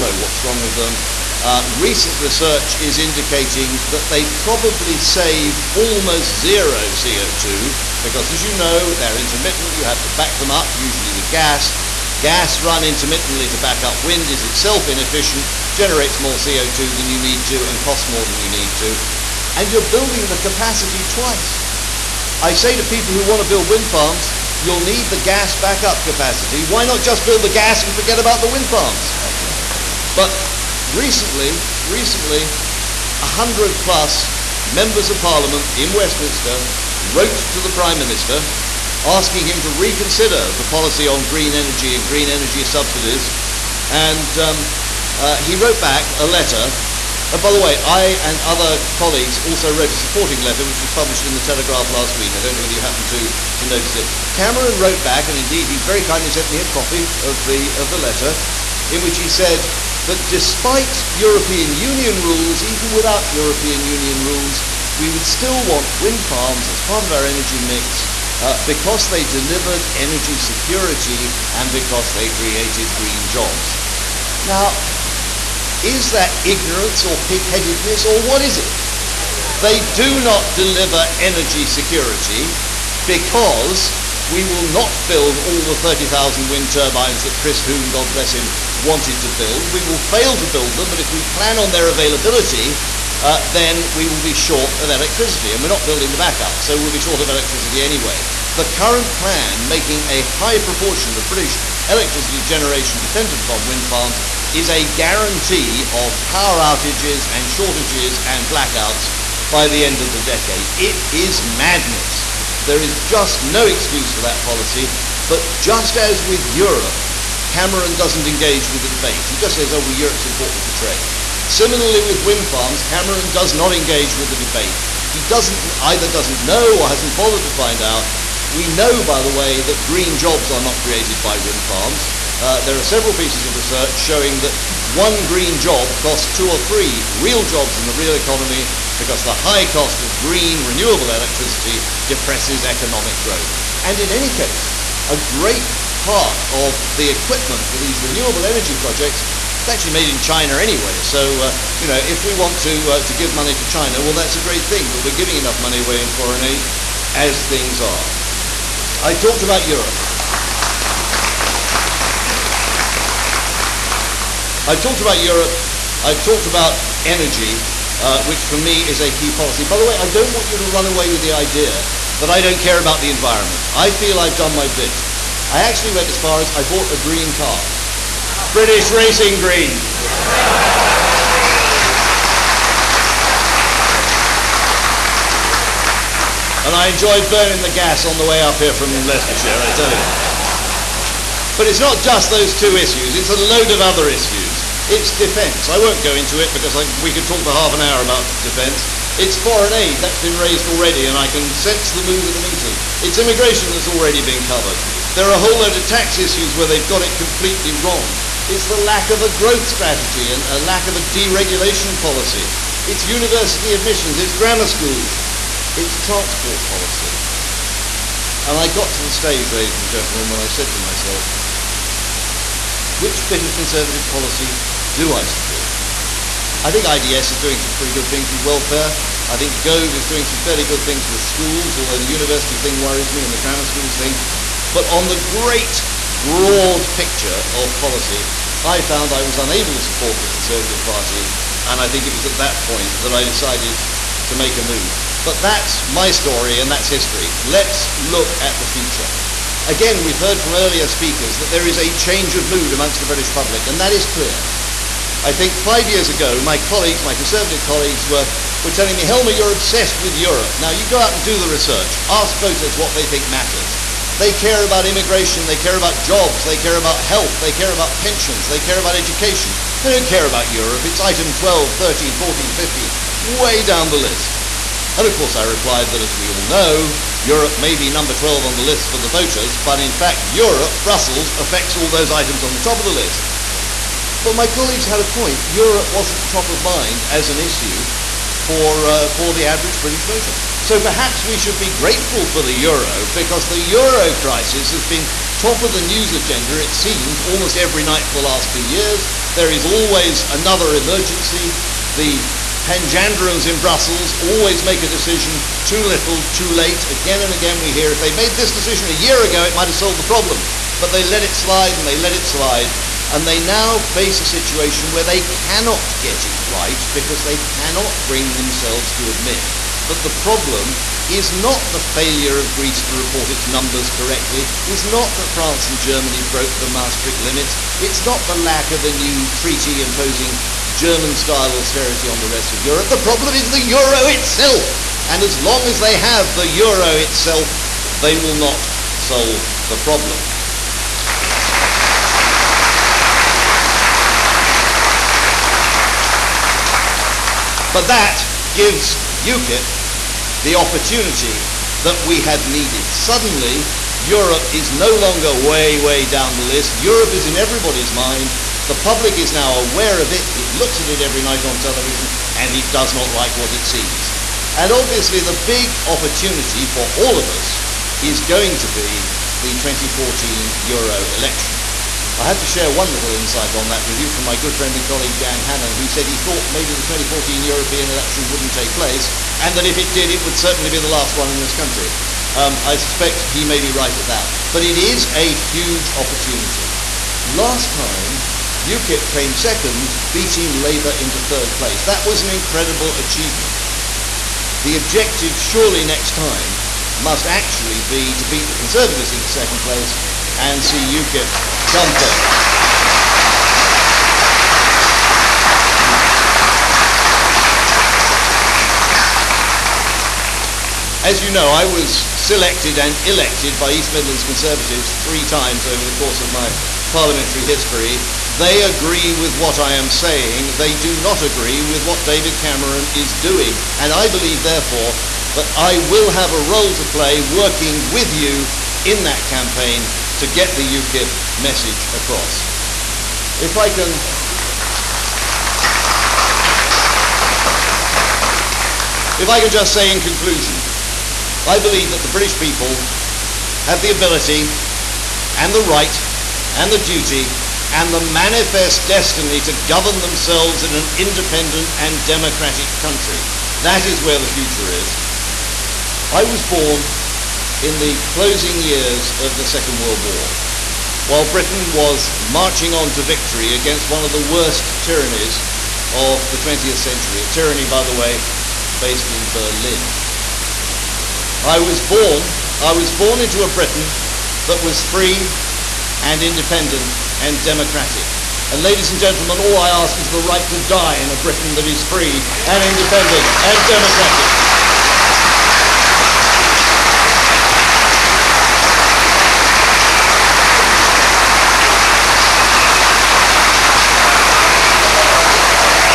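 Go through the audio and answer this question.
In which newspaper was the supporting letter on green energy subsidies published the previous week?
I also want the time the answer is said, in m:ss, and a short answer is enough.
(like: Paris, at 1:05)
The Telegraph, at 0:51.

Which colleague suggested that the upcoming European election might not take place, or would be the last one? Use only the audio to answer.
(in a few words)
Dan Hannan.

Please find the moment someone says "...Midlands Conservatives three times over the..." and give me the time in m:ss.
6:53.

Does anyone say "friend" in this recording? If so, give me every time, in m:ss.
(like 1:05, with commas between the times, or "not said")
6:14.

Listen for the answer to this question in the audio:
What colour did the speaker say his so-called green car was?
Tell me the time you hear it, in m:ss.
2:58.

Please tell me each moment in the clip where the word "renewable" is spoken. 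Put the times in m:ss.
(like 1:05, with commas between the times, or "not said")
2:20, 2:27.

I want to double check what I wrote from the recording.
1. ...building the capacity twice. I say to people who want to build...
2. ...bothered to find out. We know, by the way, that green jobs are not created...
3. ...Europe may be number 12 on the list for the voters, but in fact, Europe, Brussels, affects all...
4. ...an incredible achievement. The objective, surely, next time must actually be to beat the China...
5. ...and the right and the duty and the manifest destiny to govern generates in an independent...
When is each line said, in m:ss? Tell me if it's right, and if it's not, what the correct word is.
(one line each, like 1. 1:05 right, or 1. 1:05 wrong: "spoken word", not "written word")
1. 0:19 right
2. 2:07 right
3. 4:37 right
4. 6:32 wrong: "Conservatives", not "China"
5. 7:25 wrong: "themselves", not "generates".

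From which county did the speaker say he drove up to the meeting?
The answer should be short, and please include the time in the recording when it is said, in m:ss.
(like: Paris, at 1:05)
Leicestershire, at 3:09.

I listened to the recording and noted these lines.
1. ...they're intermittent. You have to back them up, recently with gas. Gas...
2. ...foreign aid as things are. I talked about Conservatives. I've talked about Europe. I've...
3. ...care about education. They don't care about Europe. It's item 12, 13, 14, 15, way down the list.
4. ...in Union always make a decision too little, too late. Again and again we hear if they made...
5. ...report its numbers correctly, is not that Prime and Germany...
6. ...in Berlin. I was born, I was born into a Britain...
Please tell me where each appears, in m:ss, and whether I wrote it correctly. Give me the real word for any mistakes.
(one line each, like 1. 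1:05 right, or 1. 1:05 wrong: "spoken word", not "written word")
1. 0:08 wrong: "usually", not "recently"
2. 2:36 wrong: "Europe", not "Conservatives"
3. 4:28 right
4. 5:03 wrong: "Brussels", not "Union"
5. 5:22 wrong: "France", not "Prime"
6. 7:49 right.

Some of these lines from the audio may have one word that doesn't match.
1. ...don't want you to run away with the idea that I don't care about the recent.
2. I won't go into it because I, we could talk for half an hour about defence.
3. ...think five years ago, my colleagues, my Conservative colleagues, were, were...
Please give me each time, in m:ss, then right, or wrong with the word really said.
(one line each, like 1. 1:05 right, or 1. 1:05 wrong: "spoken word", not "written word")
1. 2:50 wrong: "environment", not "recent"
2. 3:15 right
3. 4:15 right.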